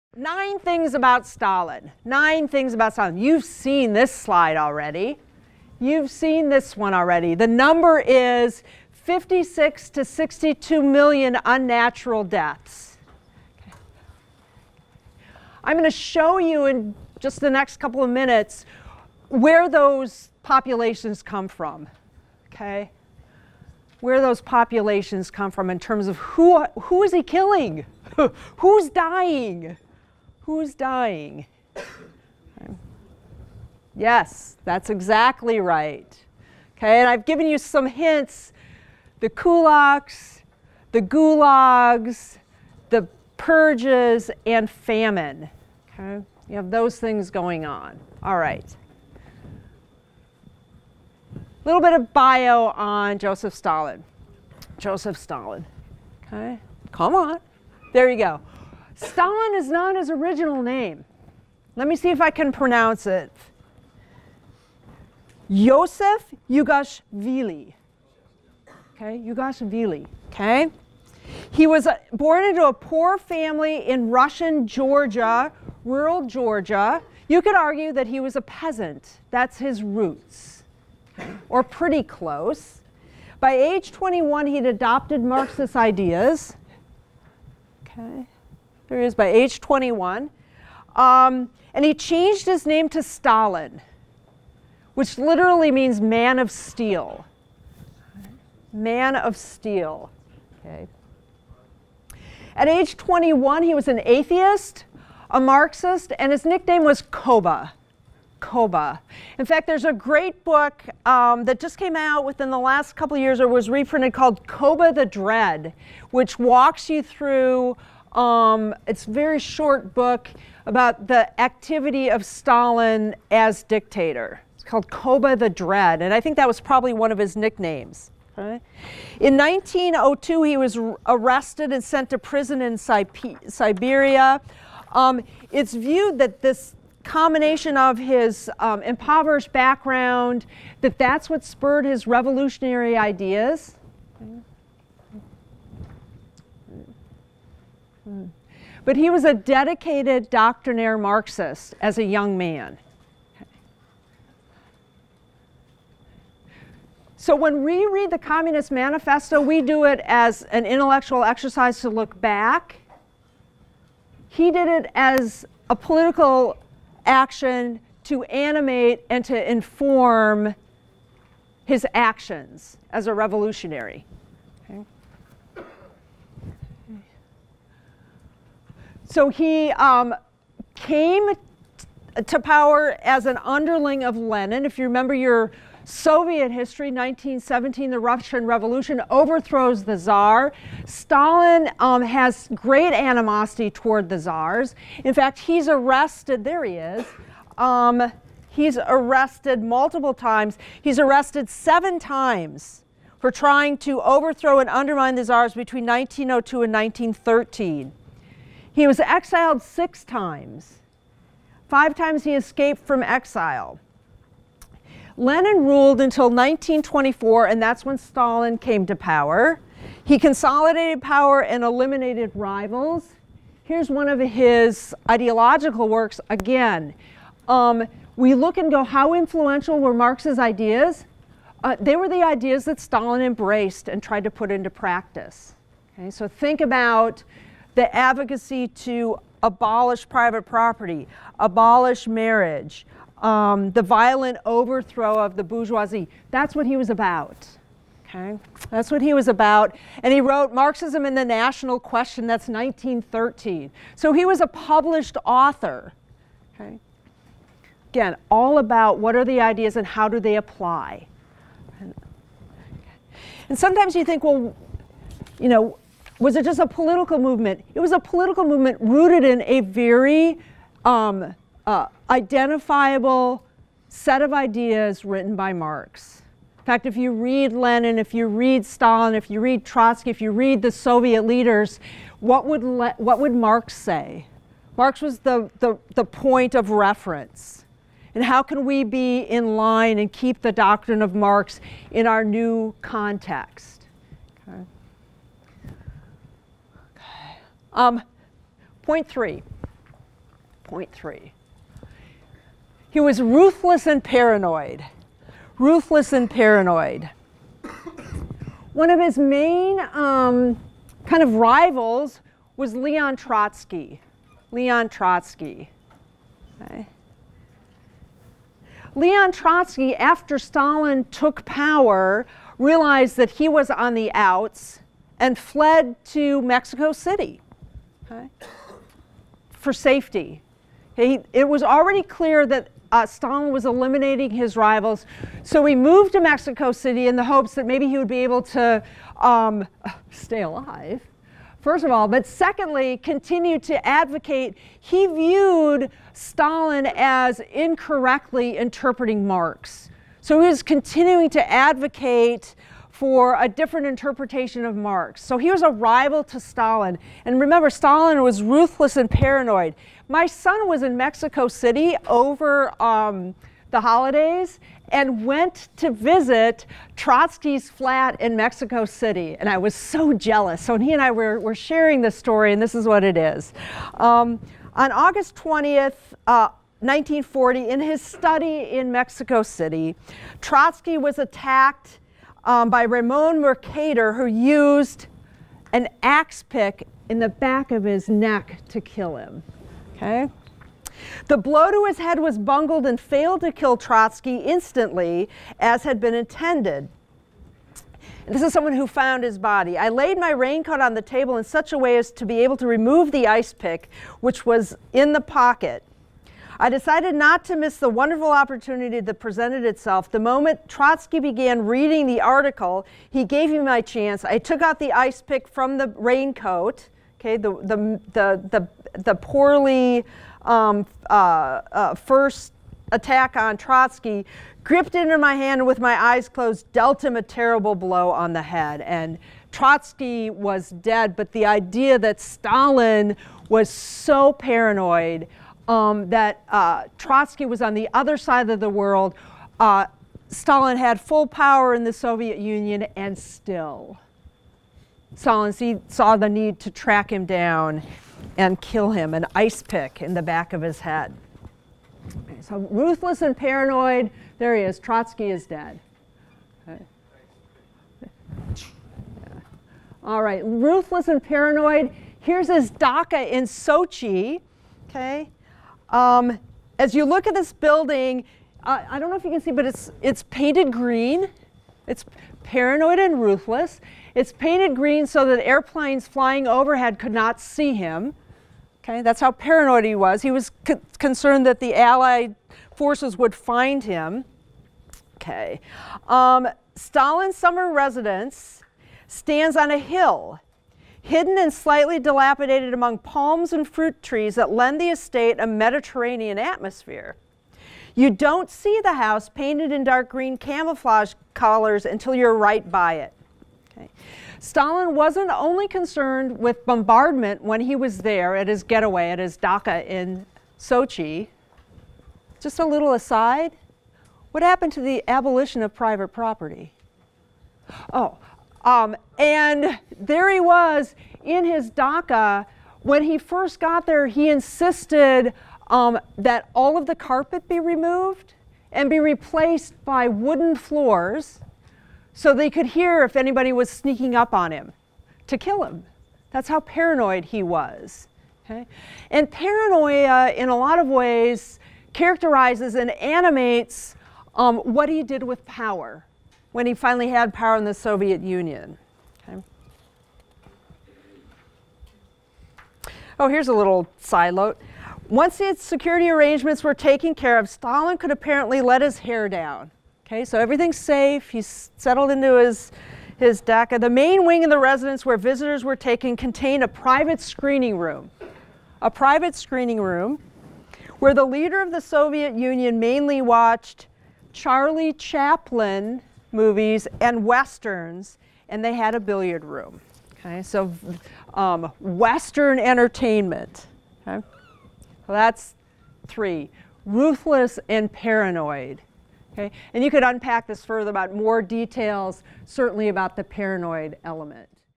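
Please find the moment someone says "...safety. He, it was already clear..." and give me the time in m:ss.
5:29.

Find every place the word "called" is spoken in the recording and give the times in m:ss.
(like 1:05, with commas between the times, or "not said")
1:54, 2:04.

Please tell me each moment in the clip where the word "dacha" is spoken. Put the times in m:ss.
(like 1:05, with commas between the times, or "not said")
7:42, 8:29, 8:41, 9:23.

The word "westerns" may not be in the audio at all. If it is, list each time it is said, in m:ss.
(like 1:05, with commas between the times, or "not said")
9:37, 9:41.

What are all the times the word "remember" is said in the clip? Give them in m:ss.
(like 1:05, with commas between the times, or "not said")
3:04, 5:57.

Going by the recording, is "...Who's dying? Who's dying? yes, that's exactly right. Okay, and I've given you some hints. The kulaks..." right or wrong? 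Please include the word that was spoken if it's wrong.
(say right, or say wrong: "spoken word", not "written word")
right.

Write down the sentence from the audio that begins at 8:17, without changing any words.
You don't see the house painted in dark green camouflage colors until you're right by it.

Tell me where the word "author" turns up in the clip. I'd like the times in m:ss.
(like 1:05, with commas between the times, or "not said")
4:15.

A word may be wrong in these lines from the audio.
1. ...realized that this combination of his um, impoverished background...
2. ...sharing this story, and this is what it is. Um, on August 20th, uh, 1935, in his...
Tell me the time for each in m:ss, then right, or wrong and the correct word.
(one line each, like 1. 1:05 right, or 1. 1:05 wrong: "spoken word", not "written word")
1. 2:15 wrong: "viewed", not "realized"
2. 6:11 wrong: "1940", not "1935".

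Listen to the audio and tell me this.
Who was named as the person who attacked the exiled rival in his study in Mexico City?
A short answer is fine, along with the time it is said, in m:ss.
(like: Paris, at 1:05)
Ramon Mercader, at 6:22.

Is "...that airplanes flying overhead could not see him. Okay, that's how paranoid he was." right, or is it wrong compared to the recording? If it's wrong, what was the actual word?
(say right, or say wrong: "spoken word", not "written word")
right.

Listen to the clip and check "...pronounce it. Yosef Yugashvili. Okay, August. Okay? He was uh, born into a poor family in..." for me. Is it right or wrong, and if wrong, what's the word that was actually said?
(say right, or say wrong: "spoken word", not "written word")
wrong: "Yugashvili", not "August".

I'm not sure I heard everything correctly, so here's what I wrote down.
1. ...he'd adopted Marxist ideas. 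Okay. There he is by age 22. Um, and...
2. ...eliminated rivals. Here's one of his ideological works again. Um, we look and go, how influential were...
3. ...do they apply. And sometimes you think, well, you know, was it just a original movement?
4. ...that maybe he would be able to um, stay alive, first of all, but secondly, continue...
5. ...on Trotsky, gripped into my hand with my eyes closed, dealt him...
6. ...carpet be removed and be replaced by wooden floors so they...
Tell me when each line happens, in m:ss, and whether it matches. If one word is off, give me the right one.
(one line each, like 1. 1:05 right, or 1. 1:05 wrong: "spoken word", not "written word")
1. 1:24 wrong: "21", not "22"
2. 3:41 right
3. 4:20 wrong: "political", not "original"
4. 5:37 right
5. 7:03 right
6. 8:46 right.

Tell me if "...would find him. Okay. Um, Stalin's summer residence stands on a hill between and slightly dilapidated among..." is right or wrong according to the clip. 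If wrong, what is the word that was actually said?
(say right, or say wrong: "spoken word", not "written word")
wrong: "hidden", not "between".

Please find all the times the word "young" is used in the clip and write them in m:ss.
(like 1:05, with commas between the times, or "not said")
2:32.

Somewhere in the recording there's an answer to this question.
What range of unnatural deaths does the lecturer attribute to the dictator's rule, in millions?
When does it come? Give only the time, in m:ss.
0:08.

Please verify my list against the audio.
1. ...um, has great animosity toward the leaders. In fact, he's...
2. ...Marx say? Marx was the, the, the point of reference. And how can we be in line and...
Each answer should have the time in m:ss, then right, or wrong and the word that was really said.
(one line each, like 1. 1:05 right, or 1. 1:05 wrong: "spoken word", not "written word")
1. 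3:11 wrong: "czars", not "leaders"
2. 4:43 right.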